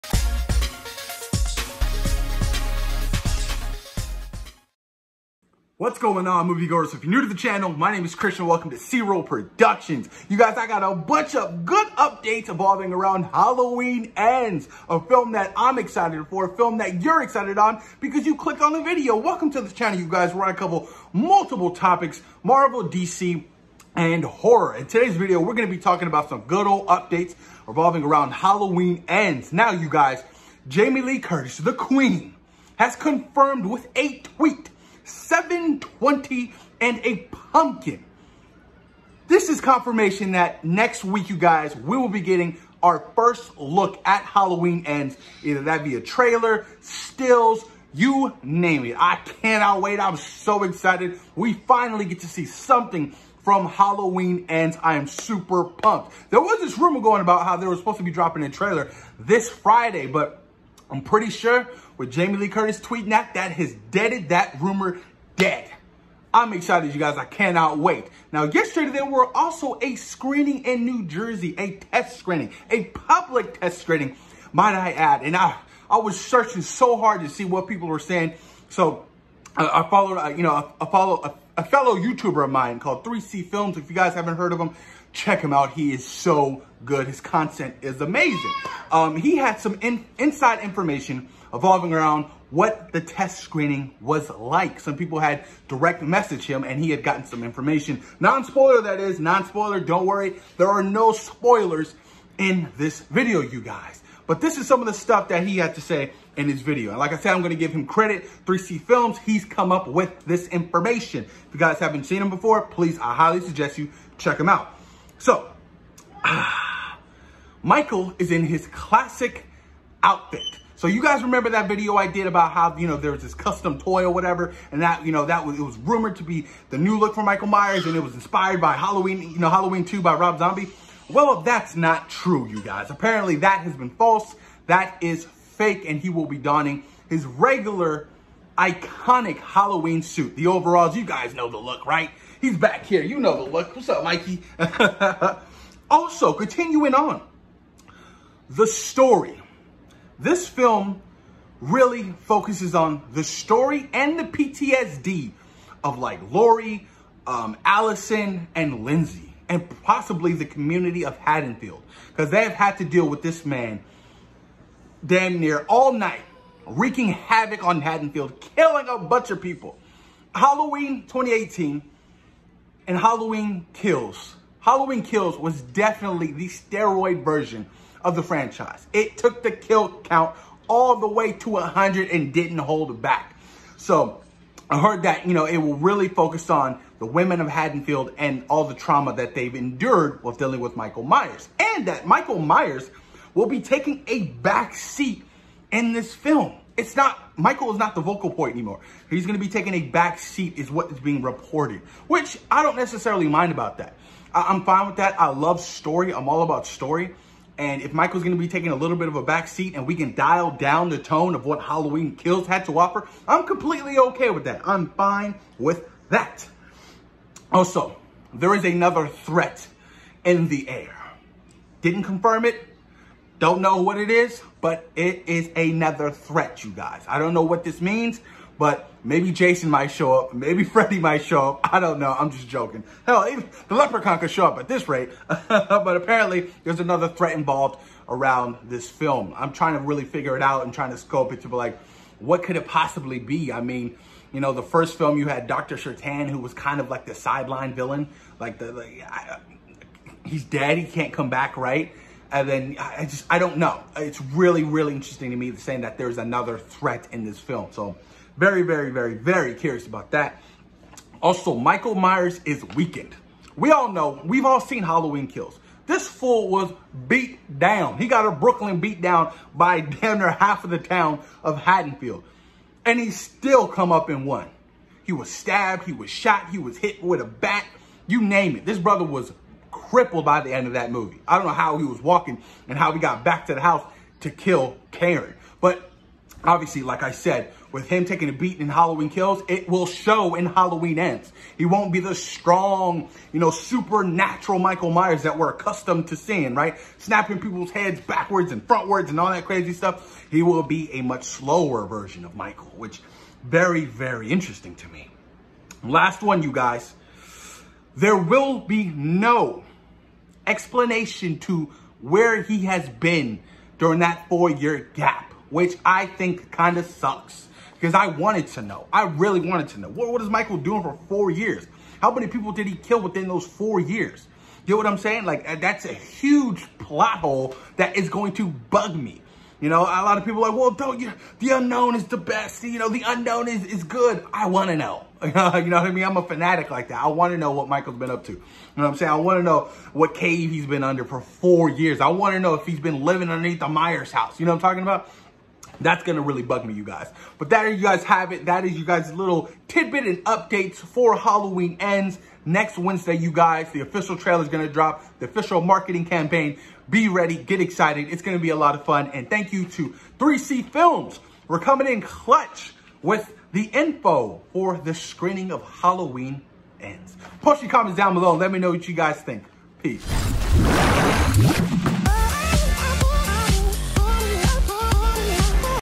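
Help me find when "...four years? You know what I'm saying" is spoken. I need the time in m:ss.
5:23.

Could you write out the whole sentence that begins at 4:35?
He was stabbed, he was shot, he was hit with a bat, you name it.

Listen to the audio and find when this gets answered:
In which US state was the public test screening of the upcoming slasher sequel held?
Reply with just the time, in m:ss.
1:10.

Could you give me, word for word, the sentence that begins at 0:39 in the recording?
This is confirmation that next week, you guys, we will be getting our first look at Halloween Ends.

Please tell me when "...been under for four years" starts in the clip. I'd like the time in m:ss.
5:40.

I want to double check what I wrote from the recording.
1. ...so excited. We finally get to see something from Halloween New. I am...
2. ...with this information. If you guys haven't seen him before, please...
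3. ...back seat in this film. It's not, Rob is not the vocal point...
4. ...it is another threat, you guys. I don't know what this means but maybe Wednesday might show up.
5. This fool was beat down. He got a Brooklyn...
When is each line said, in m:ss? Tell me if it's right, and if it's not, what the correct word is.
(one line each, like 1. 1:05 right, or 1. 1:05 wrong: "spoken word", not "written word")
1. 0:50 wrong: "Ends", not "New"
2. 1:49 right
3. 3:14 wrong: "Michael", not "Rob"
4. 3:44 wrong: "Jason", not "Wednesday"
5. 4:25 right.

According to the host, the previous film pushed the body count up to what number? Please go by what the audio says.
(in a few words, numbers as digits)
100.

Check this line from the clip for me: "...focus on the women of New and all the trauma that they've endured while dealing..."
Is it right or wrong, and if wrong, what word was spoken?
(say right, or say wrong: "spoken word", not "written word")
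wrong: "Haddonfield", not "New".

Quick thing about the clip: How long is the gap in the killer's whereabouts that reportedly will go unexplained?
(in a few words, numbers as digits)
4 years.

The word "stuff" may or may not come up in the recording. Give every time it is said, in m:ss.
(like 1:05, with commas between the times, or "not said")
1:44, 4:59.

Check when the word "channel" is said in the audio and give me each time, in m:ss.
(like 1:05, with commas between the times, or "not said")
0:07, 0:19.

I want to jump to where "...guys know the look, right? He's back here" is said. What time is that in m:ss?
2:21.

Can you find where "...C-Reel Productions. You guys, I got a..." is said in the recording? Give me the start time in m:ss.
0:08.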